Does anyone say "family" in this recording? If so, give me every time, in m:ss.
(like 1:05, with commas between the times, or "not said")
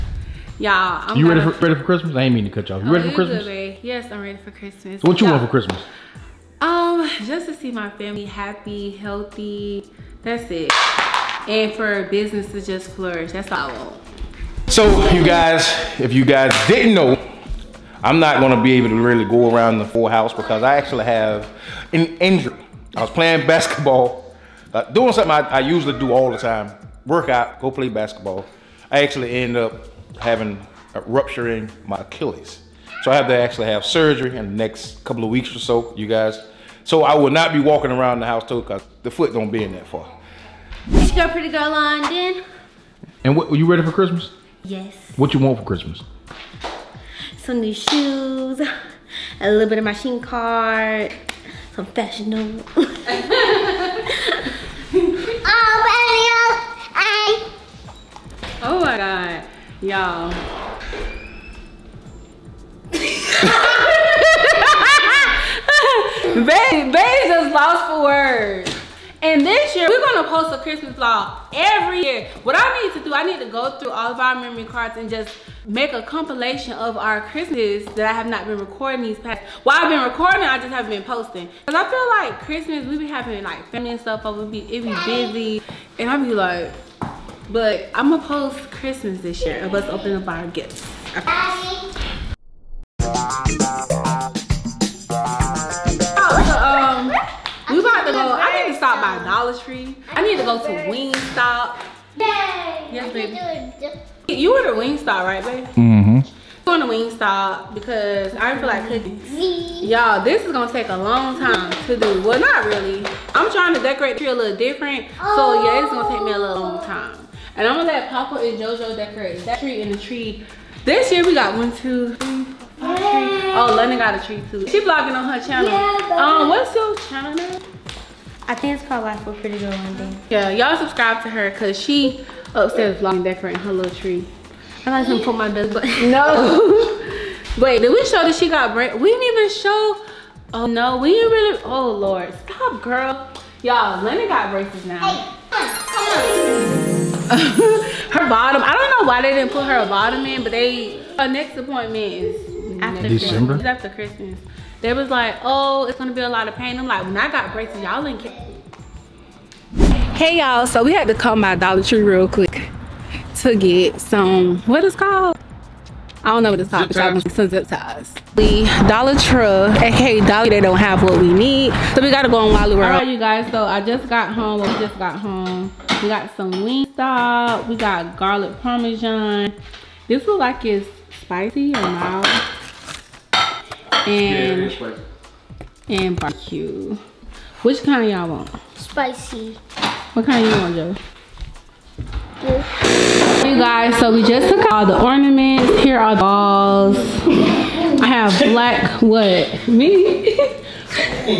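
0:07, 1:23.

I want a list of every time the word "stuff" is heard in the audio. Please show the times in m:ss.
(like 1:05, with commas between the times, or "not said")
1:24.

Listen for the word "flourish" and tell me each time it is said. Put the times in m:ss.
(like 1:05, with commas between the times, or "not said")
0:12.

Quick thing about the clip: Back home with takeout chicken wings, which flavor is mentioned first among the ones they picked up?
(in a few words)
garlic parmesan.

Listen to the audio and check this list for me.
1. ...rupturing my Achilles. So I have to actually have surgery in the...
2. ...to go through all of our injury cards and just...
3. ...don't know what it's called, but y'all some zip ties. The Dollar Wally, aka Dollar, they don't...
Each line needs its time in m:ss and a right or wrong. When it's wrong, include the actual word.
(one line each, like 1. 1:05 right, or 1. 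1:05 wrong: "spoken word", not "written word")
1. 0:31 right
2. 1:13 wrong: "memory", not "injury"
3. 2:46 wrong: "Tree", not "Wally".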